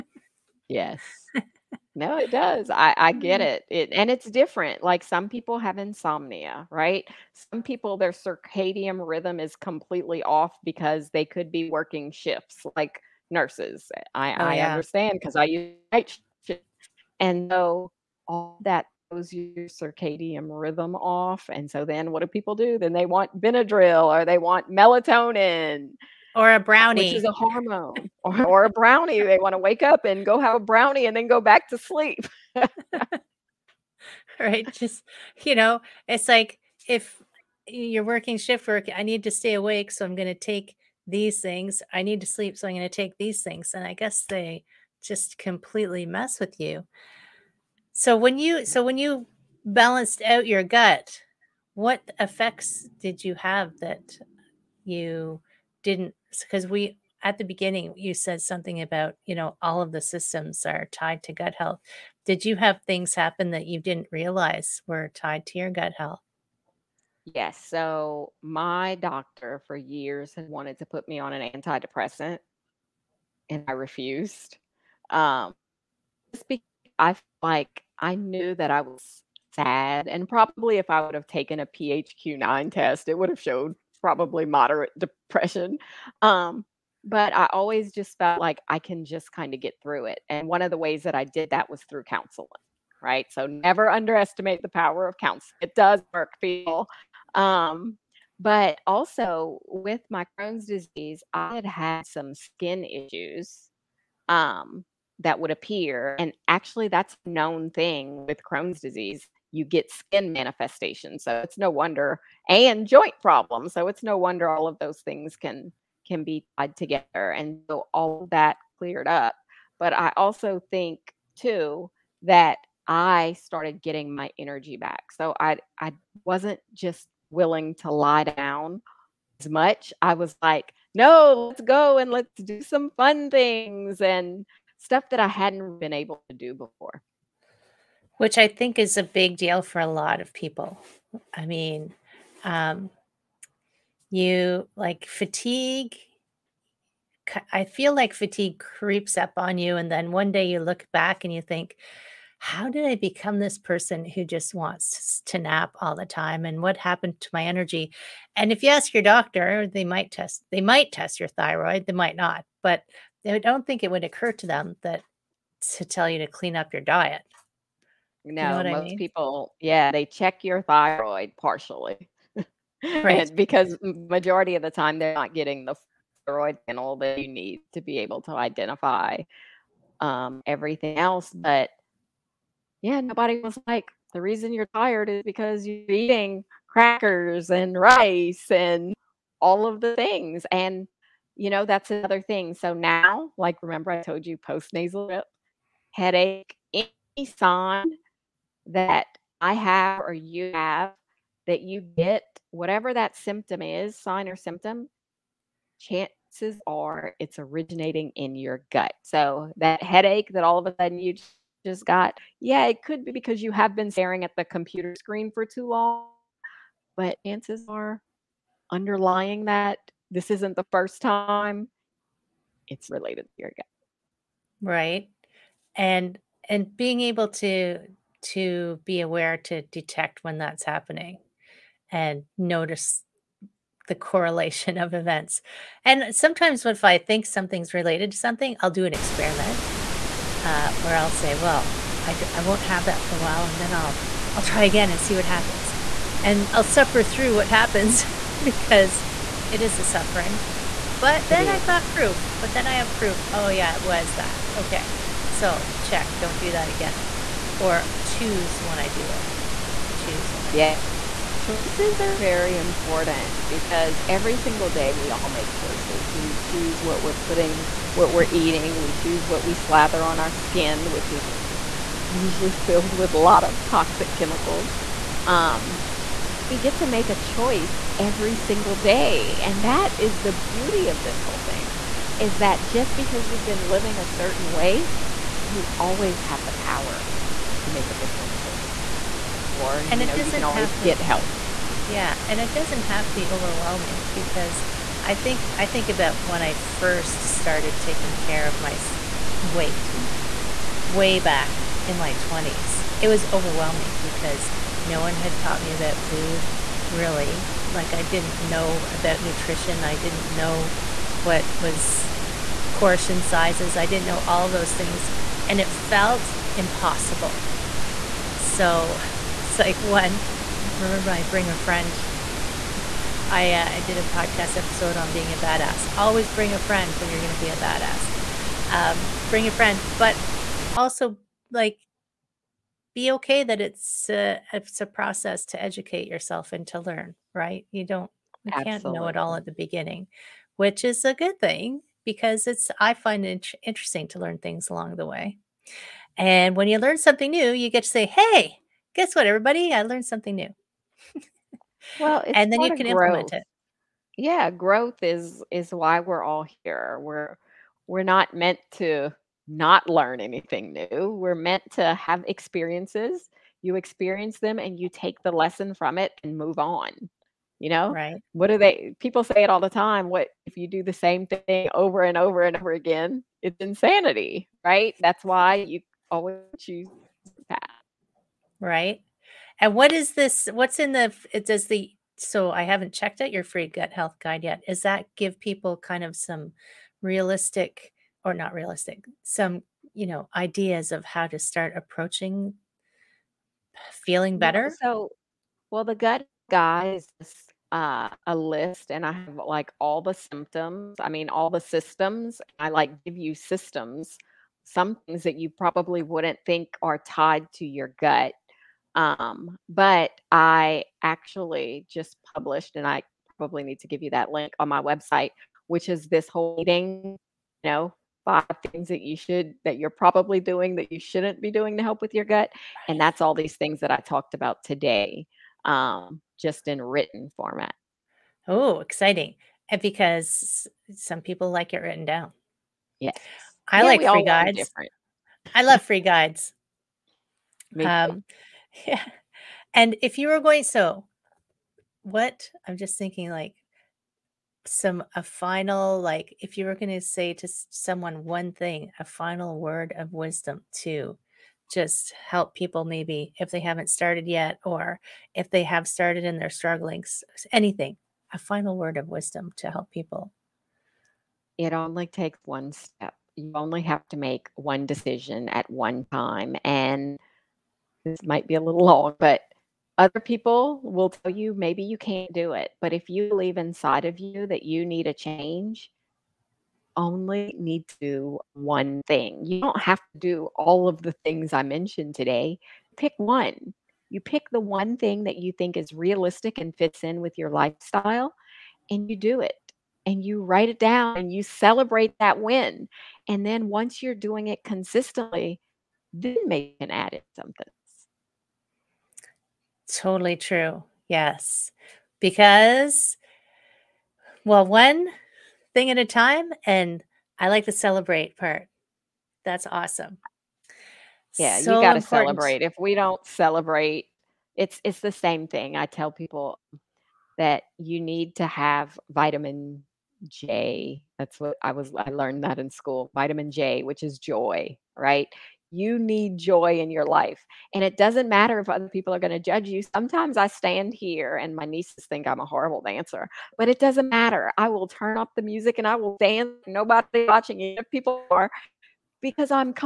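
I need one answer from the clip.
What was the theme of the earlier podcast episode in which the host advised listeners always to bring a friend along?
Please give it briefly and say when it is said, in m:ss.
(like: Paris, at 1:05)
being a badass, at 5:25.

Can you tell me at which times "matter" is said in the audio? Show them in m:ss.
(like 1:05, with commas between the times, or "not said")
8:48, 8:54.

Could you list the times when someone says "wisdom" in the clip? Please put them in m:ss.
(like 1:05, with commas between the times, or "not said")
7:30, 7:39.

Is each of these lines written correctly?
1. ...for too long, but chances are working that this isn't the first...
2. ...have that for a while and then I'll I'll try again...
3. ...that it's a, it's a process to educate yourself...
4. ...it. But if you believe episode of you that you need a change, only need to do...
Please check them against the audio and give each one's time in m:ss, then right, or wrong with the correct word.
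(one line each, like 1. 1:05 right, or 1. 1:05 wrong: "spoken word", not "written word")
1. 3:35 wrong: "underlying", not "working"
2. 4:02 right
3. 5:33 right
4. 7:52 wrong: "inside", not "episode".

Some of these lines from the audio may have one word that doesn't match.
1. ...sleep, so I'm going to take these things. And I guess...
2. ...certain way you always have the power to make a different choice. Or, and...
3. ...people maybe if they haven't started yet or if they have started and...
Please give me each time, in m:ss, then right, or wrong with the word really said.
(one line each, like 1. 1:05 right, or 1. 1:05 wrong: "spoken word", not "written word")
1. 0:42 right
2. 4:44 right
3. 7:32 right.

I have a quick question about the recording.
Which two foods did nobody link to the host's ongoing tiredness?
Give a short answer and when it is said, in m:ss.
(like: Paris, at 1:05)
crackers and rice, at 3:06.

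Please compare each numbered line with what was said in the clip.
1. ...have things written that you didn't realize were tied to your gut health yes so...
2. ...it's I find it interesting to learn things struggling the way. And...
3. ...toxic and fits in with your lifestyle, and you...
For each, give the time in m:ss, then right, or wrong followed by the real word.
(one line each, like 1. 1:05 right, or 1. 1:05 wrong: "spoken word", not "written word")
1. 1:02 wrong: "happen", not "written"
2. 5:42 wrong: "along", not "struggling"
3. 8:05 wrong: "realistic", not "toxic".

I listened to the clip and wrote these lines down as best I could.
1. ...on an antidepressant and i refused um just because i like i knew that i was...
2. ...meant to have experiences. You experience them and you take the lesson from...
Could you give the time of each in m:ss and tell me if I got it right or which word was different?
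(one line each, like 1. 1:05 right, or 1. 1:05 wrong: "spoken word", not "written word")
1. 1:11 right
2. 6:01 right.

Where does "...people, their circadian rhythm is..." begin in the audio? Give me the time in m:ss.
0:07.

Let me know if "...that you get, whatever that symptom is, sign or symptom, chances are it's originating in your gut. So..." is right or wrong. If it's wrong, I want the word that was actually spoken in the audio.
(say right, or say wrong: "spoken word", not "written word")
right.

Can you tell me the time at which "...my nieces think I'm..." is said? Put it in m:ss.
8:51.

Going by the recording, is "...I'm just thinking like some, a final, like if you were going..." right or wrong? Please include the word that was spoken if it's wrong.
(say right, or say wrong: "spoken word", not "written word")
right.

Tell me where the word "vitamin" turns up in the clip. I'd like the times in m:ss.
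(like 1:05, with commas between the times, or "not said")
8:39, 8:43.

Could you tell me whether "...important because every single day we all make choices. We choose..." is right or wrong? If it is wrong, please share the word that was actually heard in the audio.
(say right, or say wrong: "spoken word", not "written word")
right.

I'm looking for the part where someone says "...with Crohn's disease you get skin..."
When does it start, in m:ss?
1:48.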